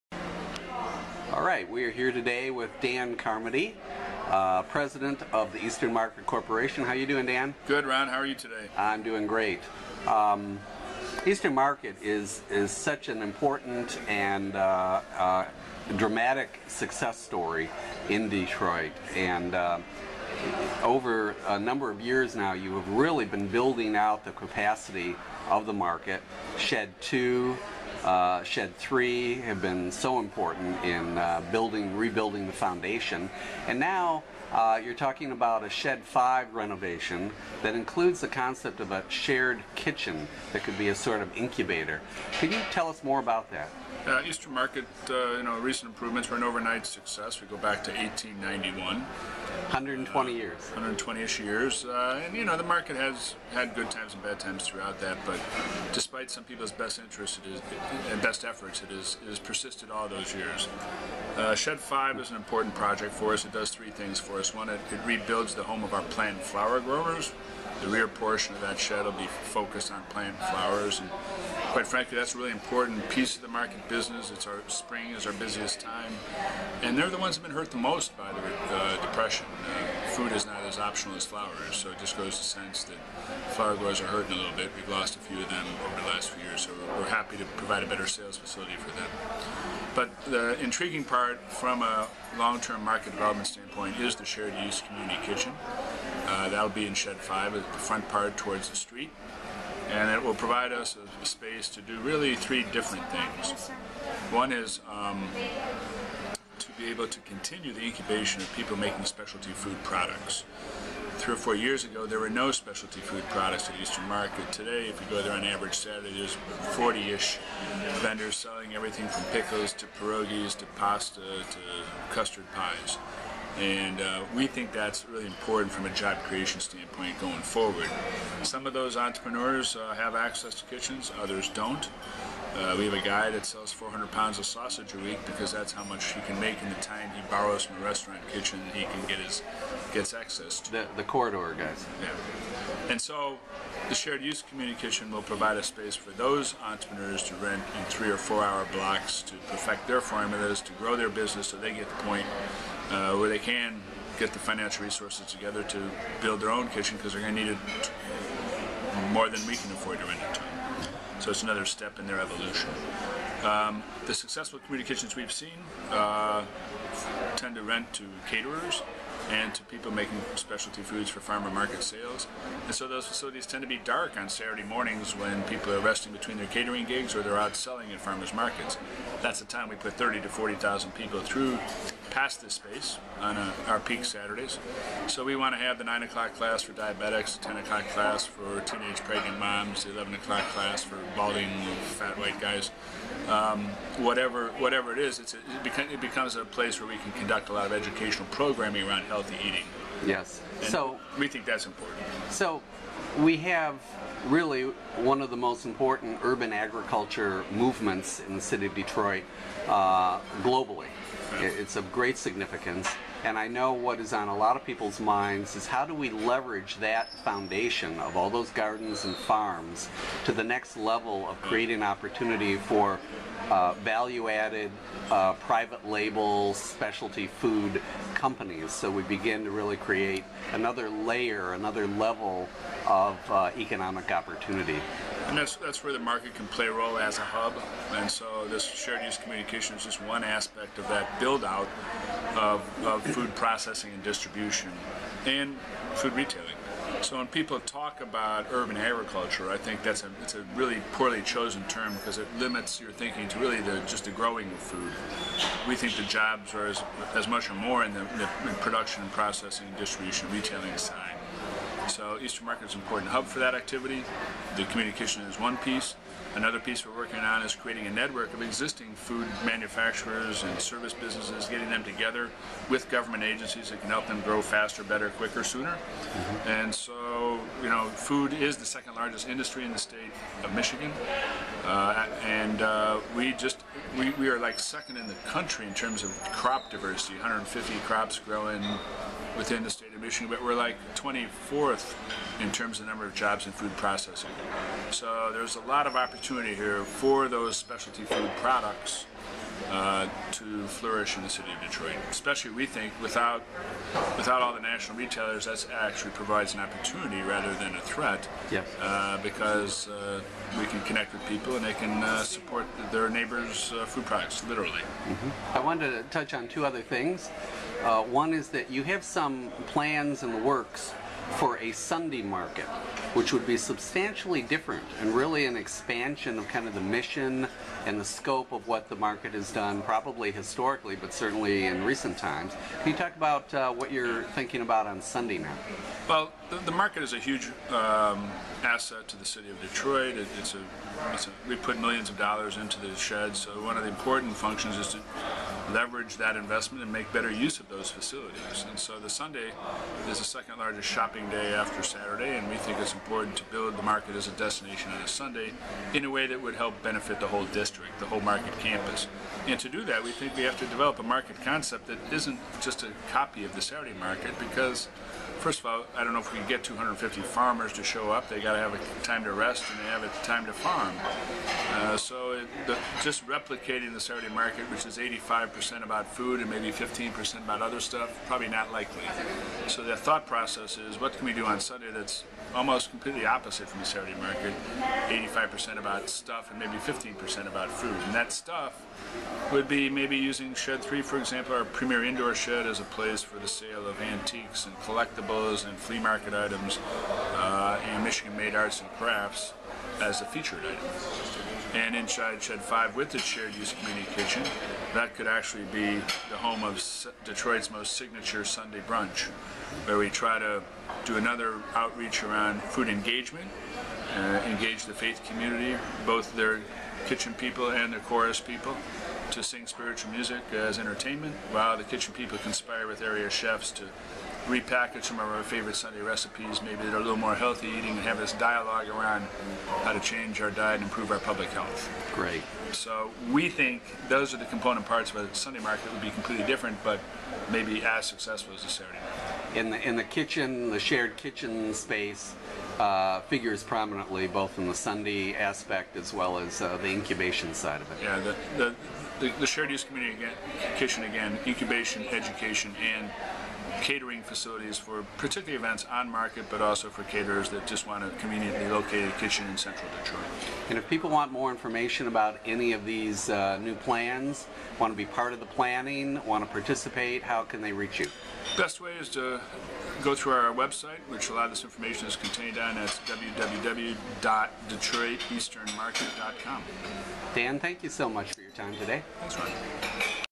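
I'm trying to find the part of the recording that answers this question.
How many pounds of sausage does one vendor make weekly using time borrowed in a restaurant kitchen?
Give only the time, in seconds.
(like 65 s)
133 s.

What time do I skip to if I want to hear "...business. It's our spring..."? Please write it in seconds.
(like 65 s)
73 s.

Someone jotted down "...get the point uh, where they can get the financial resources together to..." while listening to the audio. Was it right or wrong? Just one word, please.
right.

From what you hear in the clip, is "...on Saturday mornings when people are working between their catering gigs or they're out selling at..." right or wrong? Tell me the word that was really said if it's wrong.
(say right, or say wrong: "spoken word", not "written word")
wrong: "resting", not "working".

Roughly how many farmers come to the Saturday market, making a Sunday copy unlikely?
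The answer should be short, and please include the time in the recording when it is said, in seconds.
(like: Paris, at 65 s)
250, at 366 s.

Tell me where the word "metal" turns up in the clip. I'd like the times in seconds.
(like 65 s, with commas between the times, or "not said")
not said.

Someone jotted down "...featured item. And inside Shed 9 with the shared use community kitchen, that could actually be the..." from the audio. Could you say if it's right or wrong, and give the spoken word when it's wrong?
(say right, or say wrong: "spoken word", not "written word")
wrong: "5", not "9".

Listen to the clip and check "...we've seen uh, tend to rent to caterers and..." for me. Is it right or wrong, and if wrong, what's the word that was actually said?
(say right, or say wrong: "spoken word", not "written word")
right.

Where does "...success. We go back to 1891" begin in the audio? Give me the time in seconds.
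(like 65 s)
46 s.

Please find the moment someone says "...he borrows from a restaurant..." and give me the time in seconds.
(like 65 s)
137 s.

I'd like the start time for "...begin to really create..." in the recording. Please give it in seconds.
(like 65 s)
229 s.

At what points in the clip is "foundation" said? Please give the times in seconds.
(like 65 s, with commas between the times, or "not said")
32 s, 217 s.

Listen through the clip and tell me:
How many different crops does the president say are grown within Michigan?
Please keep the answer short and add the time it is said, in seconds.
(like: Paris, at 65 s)
150, at 287 s.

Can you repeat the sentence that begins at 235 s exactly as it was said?
And that's, that's where the market can play a role as a hub.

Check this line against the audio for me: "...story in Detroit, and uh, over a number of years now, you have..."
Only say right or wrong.
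right.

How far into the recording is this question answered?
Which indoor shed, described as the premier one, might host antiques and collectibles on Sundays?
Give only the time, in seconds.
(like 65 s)
390 s.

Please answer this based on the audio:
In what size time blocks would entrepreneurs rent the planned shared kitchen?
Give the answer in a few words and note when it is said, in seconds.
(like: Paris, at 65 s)
3 or 4 hours, at 147 s.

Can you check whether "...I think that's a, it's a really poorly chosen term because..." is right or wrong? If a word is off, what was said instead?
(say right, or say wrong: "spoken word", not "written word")
right.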